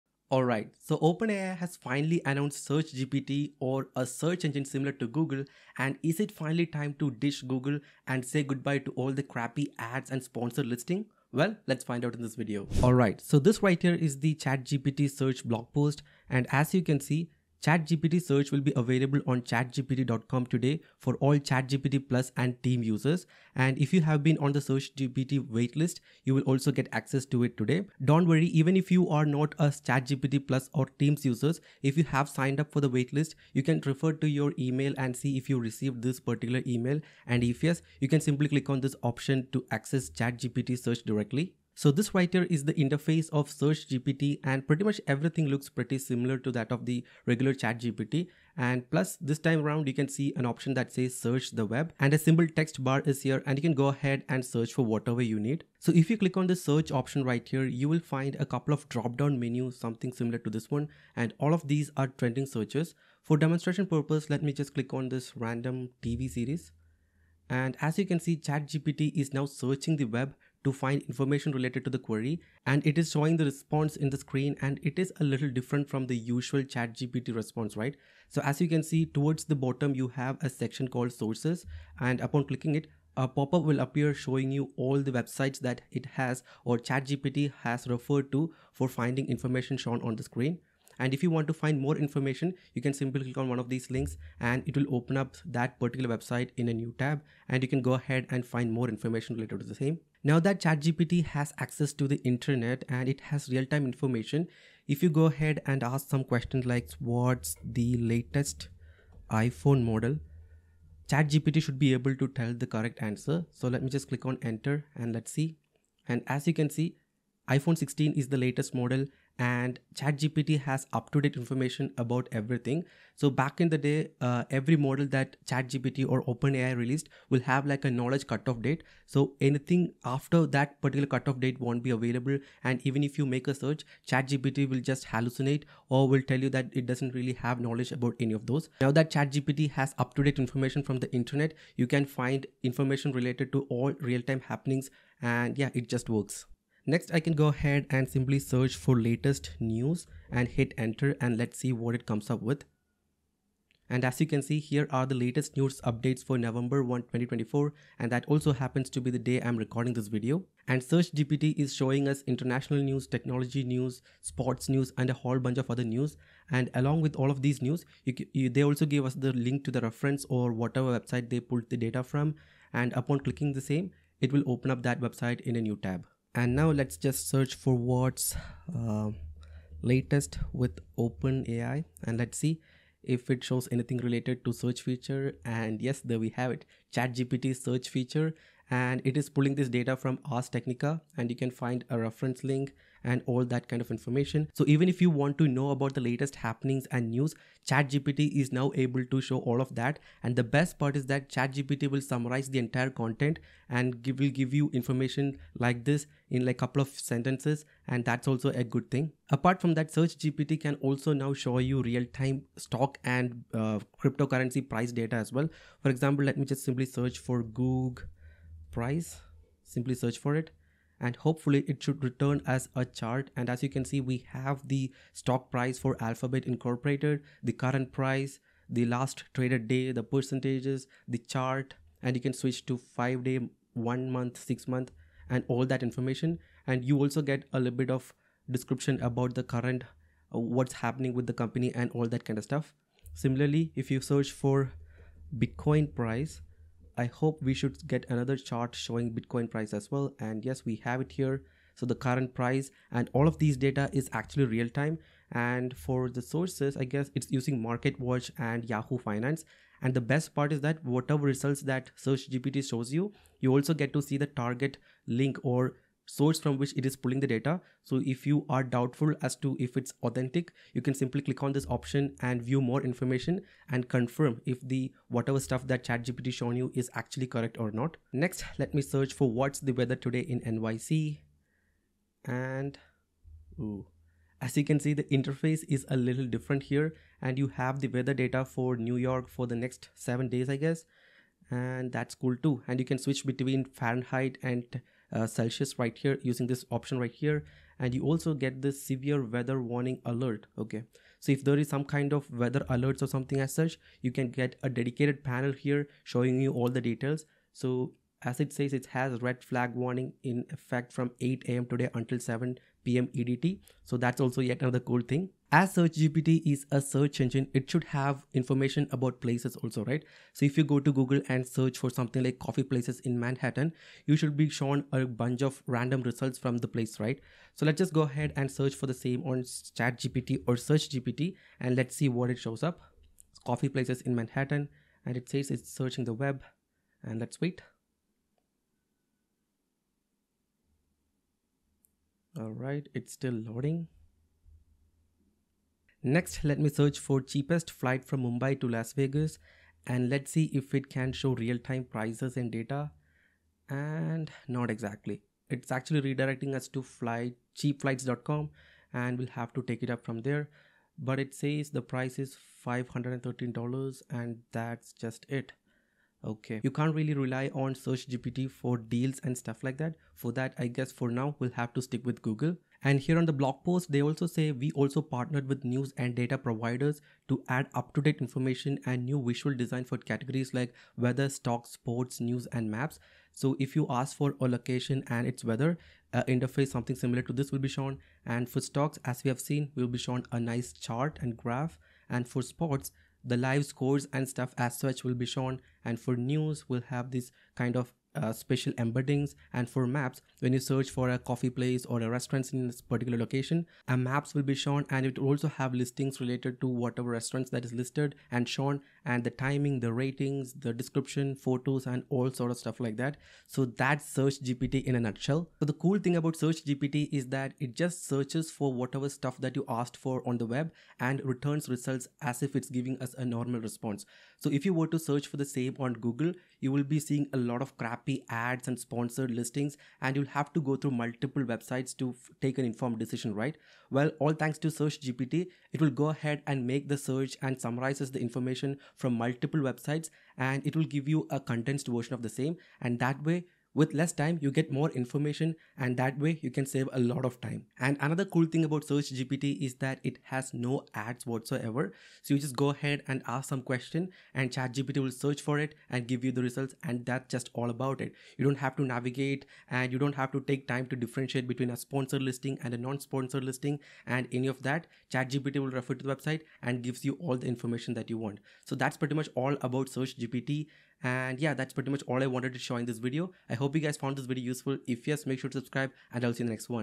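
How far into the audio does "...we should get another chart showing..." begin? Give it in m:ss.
4:07.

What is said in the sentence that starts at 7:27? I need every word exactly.
And another cool thing about Search GPT is that it has no ads whatsoever.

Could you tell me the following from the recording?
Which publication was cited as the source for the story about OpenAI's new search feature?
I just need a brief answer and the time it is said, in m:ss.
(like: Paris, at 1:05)
Ars Technica, at 3:10.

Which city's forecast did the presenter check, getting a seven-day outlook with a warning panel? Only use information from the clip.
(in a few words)
NYC.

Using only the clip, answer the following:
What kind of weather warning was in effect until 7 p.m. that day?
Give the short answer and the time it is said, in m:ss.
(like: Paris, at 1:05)
Red flag warning, at 5:09.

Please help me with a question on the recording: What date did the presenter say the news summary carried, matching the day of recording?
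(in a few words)
November 1, 2024.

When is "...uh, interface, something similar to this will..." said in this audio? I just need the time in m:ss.
6:26.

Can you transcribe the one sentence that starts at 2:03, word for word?
So, back in the day, uh, every model that ChatGPT or OpenAI released will have like a knowledge cutoff date.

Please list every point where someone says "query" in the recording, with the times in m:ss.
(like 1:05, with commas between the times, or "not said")
1:11.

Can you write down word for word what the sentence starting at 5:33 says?
It's coffee places in Manhattan and it says it's searching the web and let's wait.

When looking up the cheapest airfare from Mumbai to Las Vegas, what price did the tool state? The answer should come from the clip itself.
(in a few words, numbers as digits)
$513.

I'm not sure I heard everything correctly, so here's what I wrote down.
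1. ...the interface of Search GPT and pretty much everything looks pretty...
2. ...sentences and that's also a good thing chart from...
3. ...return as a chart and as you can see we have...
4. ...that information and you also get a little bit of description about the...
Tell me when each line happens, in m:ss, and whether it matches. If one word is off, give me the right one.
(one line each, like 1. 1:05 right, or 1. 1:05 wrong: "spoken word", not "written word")
1. 0:42 right
2. 3:26 wrong: "apart", not "chart"
3. 3:42 right
4. 3:55 right.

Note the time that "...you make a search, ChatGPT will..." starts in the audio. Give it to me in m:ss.
2:13.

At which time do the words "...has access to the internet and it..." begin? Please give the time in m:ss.
1:41.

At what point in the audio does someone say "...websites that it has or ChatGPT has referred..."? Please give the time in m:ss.
1:25.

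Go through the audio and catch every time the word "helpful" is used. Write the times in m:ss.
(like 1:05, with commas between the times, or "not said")
not said.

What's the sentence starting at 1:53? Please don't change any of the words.
So let me just click on enter and let's see.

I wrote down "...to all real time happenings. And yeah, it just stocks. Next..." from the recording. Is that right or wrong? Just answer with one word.
wrong.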